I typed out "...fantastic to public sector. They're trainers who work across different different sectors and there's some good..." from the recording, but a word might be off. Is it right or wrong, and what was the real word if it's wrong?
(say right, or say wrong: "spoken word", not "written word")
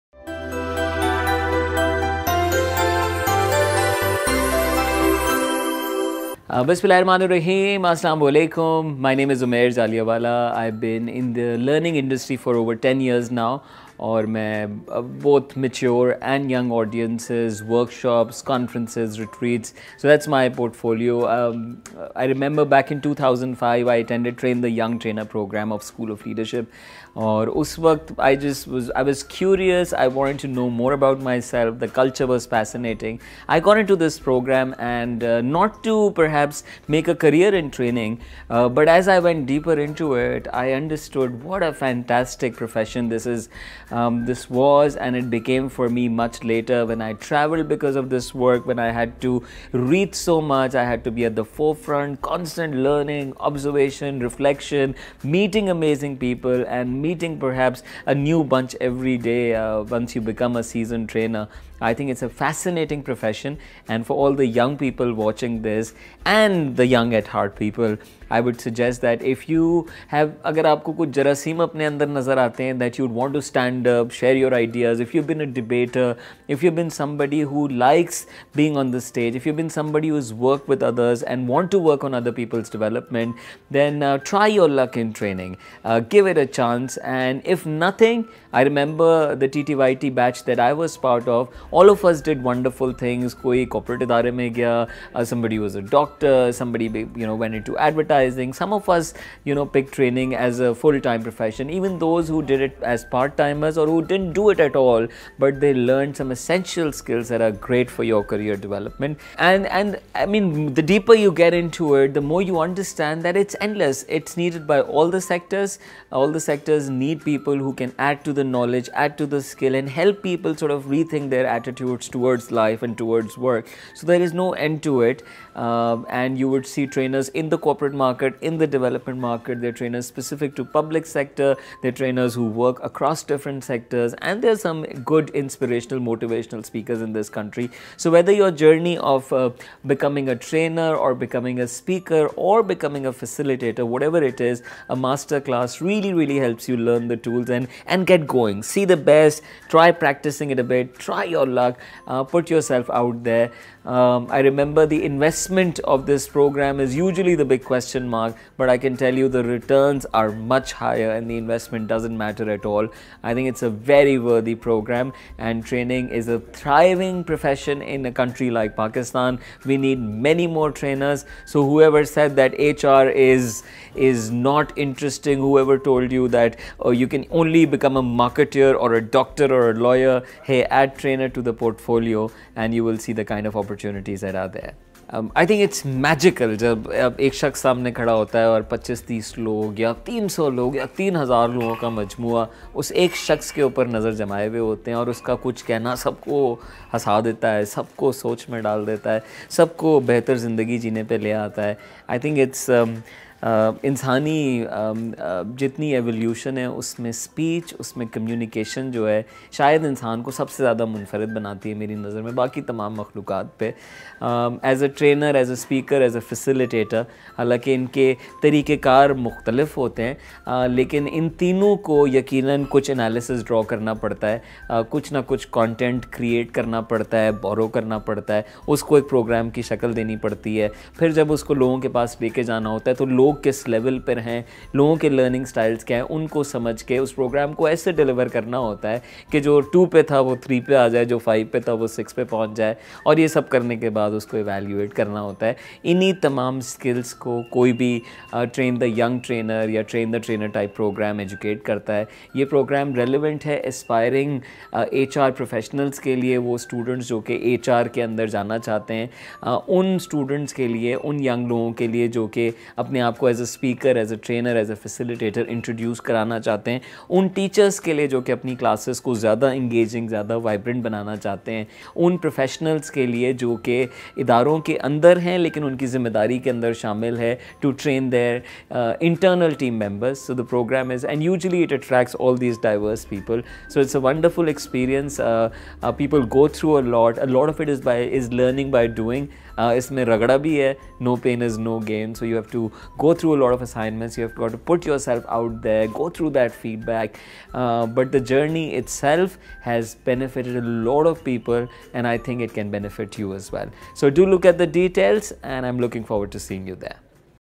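wrong: "specific", not "fantastic".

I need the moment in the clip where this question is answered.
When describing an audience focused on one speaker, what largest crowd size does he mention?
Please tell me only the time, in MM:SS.
03:10.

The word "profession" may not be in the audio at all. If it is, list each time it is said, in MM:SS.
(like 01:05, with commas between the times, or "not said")
00:42, 01:03, 01:41, 02:47.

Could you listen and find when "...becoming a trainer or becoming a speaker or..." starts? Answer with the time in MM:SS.
02:19.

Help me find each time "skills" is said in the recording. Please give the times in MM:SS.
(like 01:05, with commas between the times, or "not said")
01:46, 01:59.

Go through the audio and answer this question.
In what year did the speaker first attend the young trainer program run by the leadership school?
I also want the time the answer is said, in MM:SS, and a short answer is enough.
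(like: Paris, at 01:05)
2005, at 00:22.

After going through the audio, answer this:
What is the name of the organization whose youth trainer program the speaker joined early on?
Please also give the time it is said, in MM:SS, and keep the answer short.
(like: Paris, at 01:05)
School of Leadership, at 00:25.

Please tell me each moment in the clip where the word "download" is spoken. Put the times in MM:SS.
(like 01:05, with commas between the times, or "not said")
not said.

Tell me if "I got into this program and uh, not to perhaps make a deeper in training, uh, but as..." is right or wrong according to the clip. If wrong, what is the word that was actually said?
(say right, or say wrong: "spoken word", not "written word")
wrong: "career", not "deeper".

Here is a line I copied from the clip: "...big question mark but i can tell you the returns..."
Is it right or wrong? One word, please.
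right.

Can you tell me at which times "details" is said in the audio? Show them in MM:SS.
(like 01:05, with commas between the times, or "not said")
05:04.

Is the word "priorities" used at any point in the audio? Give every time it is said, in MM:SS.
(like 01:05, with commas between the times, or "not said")
not said.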